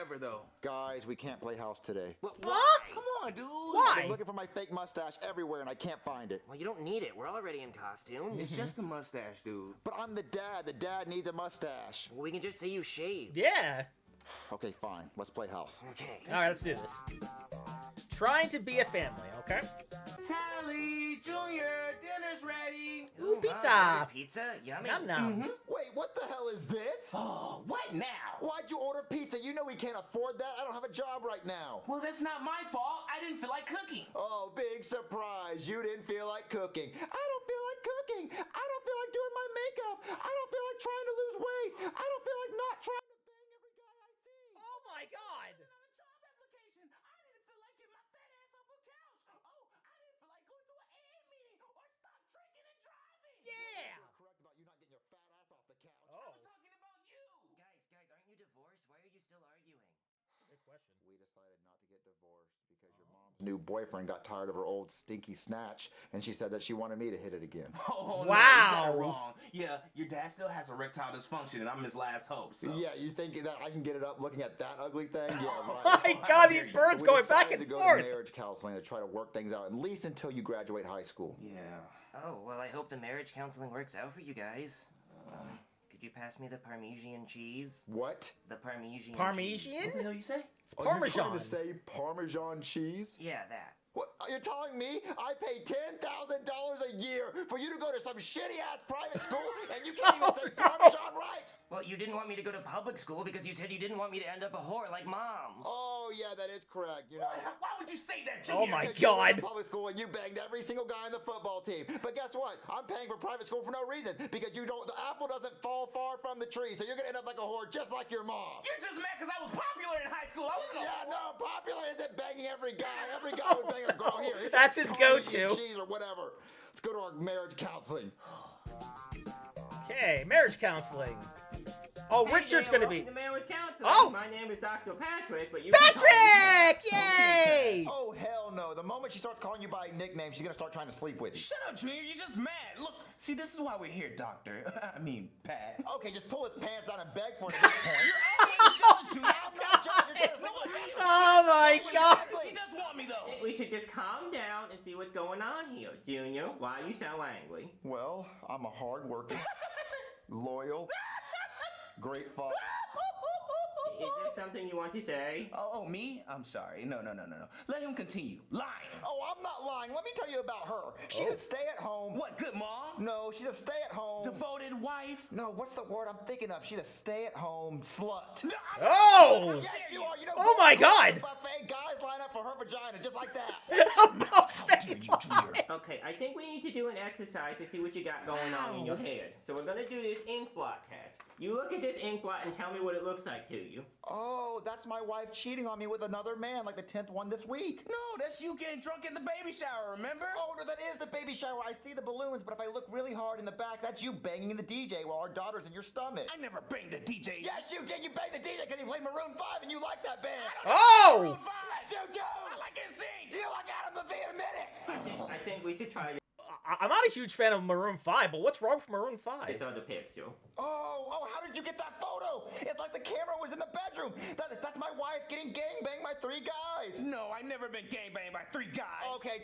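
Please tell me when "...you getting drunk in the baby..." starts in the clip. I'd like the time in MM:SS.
03:18.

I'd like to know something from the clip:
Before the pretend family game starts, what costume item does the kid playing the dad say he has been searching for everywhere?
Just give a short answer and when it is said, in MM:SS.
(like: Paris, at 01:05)
Fake mustache, at 00:04.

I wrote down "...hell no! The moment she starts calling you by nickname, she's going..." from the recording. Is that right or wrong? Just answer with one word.
right.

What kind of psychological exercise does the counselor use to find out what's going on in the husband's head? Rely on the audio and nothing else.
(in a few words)
Ink blot test.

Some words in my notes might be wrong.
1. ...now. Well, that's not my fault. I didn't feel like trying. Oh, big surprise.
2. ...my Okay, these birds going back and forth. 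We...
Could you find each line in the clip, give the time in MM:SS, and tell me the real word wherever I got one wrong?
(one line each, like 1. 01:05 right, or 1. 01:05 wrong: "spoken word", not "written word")
1. 00:31 wrong: "cooking", not "trying"
2. 01:16 wrong: "God", not "Okay".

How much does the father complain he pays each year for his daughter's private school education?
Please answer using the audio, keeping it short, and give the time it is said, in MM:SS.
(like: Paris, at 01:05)
$10,000, at 01:35.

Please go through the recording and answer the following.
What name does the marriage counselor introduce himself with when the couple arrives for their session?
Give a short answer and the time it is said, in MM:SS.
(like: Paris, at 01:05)
Dr. Patrick, at 02:14.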